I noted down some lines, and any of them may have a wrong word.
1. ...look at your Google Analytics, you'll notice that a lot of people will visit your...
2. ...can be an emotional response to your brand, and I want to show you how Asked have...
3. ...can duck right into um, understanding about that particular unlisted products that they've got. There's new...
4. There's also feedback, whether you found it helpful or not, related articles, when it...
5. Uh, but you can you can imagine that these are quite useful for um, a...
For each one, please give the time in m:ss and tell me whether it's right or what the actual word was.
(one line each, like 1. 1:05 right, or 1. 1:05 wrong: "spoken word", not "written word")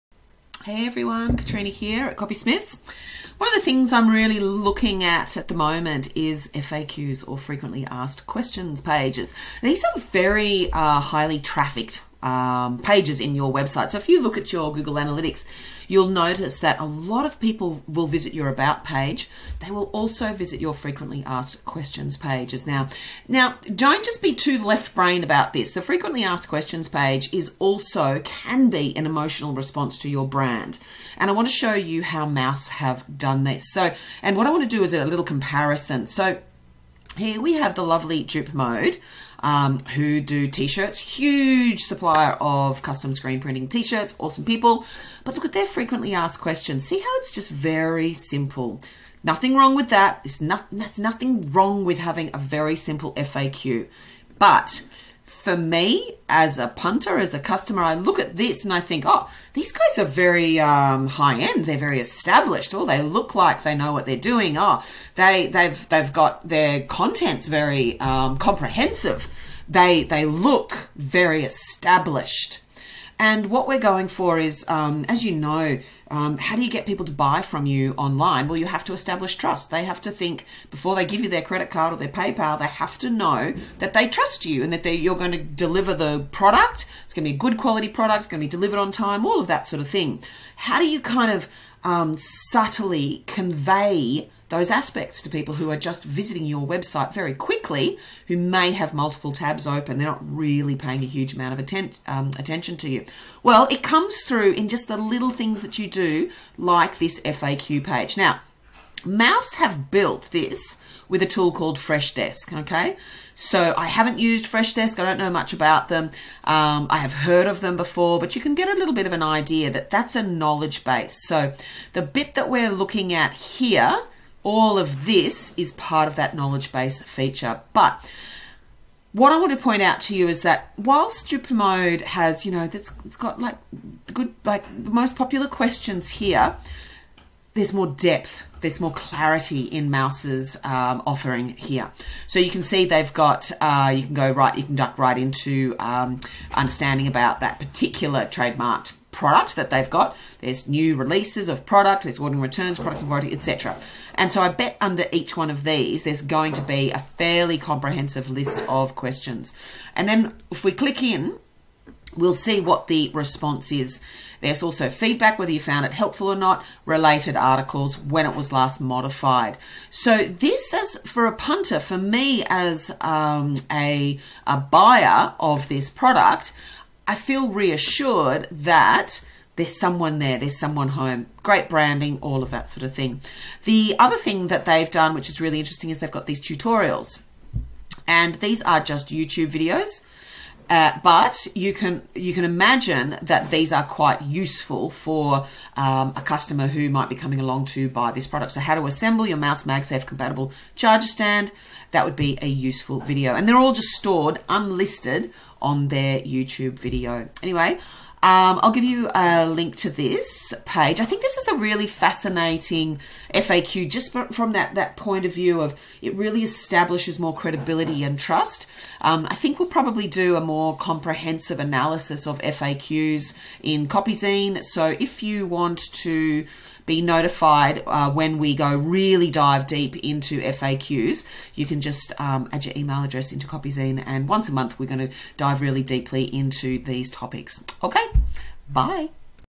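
1. 0:14 right
2. 0:28 wrong: "Mous", not "Asked"
3. 2:24 wrong: "trademarked", not "unlisted"
4. 2:44 right
5. 3:10 right.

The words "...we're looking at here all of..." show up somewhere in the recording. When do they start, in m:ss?
2:02.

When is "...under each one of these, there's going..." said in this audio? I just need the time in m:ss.
2:34.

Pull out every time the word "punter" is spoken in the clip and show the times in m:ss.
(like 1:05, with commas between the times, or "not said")
0:56, 2:51.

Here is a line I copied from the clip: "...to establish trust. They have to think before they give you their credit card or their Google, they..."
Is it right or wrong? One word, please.
wrong.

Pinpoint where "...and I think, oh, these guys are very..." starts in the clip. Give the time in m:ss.
0:58.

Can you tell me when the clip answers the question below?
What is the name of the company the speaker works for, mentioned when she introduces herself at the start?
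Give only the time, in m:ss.
0:02.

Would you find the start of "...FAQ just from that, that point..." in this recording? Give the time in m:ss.
3:33.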